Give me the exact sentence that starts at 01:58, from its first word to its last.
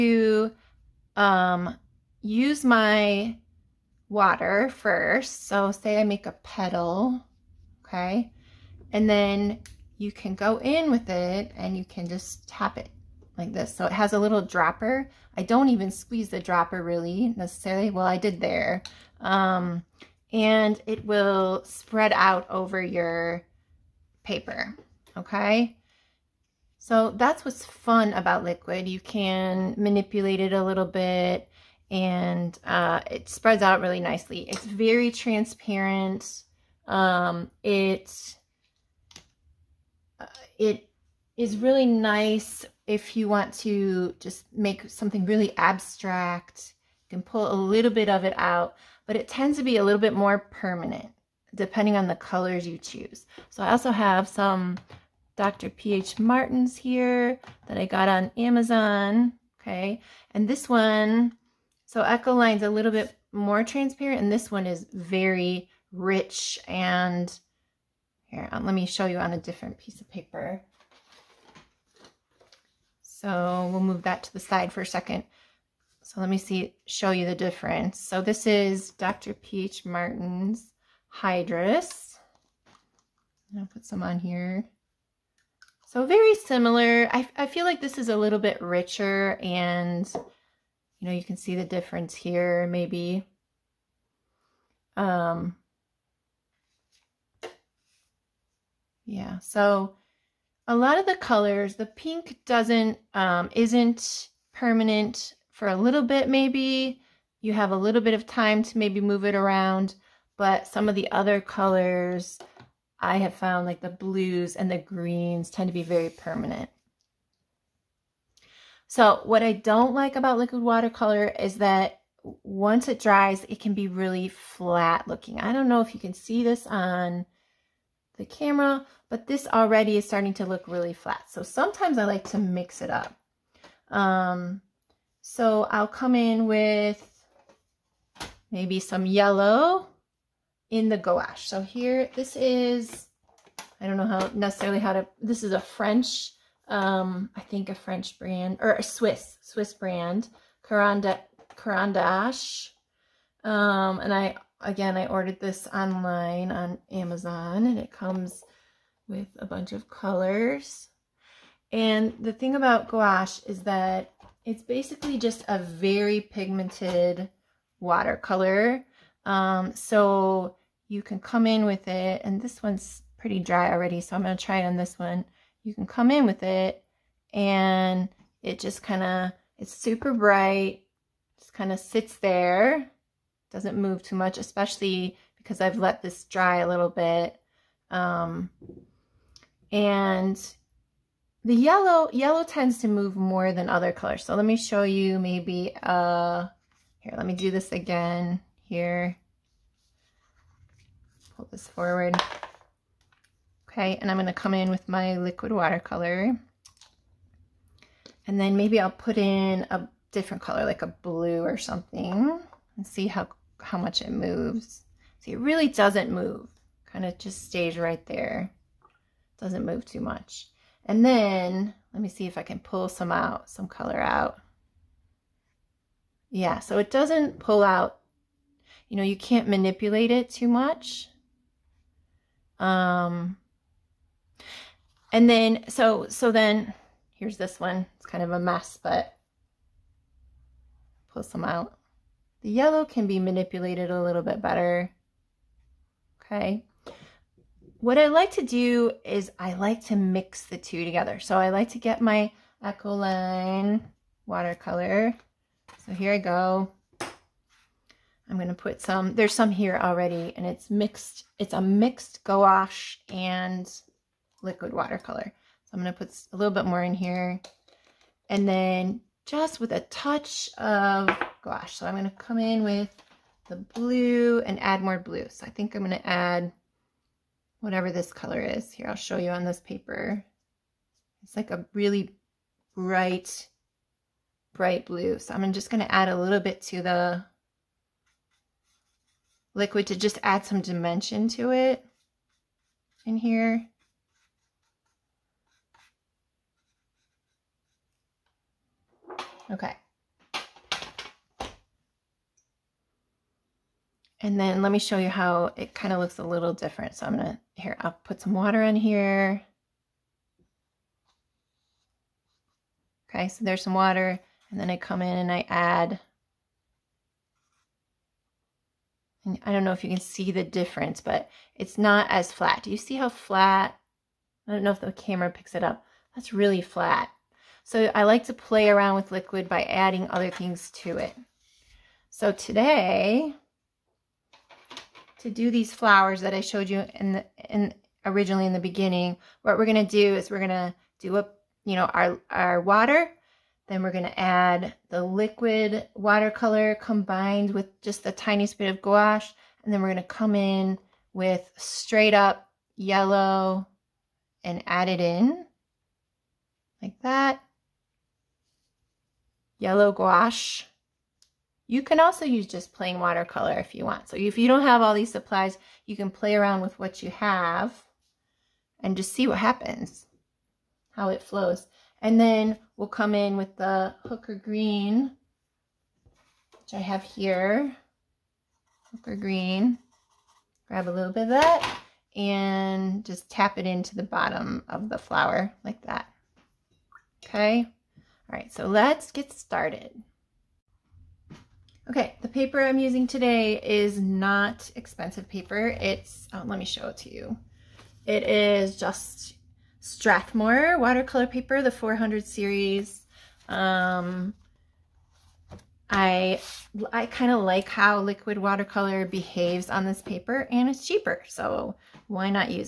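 So what I don't like about liquid watercolor is that once it dries, it can be really flat looking.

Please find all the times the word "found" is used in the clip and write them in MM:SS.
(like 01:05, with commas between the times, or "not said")
01:53.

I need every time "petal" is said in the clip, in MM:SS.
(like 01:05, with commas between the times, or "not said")
00:06.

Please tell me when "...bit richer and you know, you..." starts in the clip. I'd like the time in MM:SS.
01:28.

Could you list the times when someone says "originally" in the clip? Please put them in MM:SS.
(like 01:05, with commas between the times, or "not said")
05:38.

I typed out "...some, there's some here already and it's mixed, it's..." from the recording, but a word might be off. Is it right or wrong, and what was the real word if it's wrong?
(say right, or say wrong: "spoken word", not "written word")
right.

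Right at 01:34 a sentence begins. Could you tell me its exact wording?
Um, yeah, so a lot of the colors, the pink doesn't, um, isn't permanent for a little bit, maybe.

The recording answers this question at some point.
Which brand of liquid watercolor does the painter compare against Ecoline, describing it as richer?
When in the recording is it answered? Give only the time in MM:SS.
01:18.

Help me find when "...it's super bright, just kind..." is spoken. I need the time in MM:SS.
02:59.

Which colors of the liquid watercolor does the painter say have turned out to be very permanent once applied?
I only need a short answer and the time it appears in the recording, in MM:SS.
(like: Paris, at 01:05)
the blues and the greens, at 01:53.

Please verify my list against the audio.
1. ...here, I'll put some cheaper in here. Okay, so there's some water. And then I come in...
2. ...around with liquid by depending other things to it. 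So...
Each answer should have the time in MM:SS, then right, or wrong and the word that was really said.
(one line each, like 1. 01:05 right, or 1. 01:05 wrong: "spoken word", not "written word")
1. 05:07 wrong: "water", not "cheaper"
2. 05:28 wrong: "adding", not "depending".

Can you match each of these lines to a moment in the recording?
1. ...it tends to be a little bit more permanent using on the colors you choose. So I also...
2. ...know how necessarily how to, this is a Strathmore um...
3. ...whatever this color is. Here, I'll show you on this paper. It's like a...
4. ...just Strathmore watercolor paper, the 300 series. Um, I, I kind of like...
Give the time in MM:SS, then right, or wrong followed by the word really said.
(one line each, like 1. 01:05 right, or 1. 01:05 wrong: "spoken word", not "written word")
1. 00:49 wrong: "depending", not "using"
2. 02:23 wrong: "French", not "Strathmore"
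3. 04:37 right
4. 06:38 wrong: "400", not "300".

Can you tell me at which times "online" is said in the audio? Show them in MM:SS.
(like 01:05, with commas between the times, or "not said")
02:35.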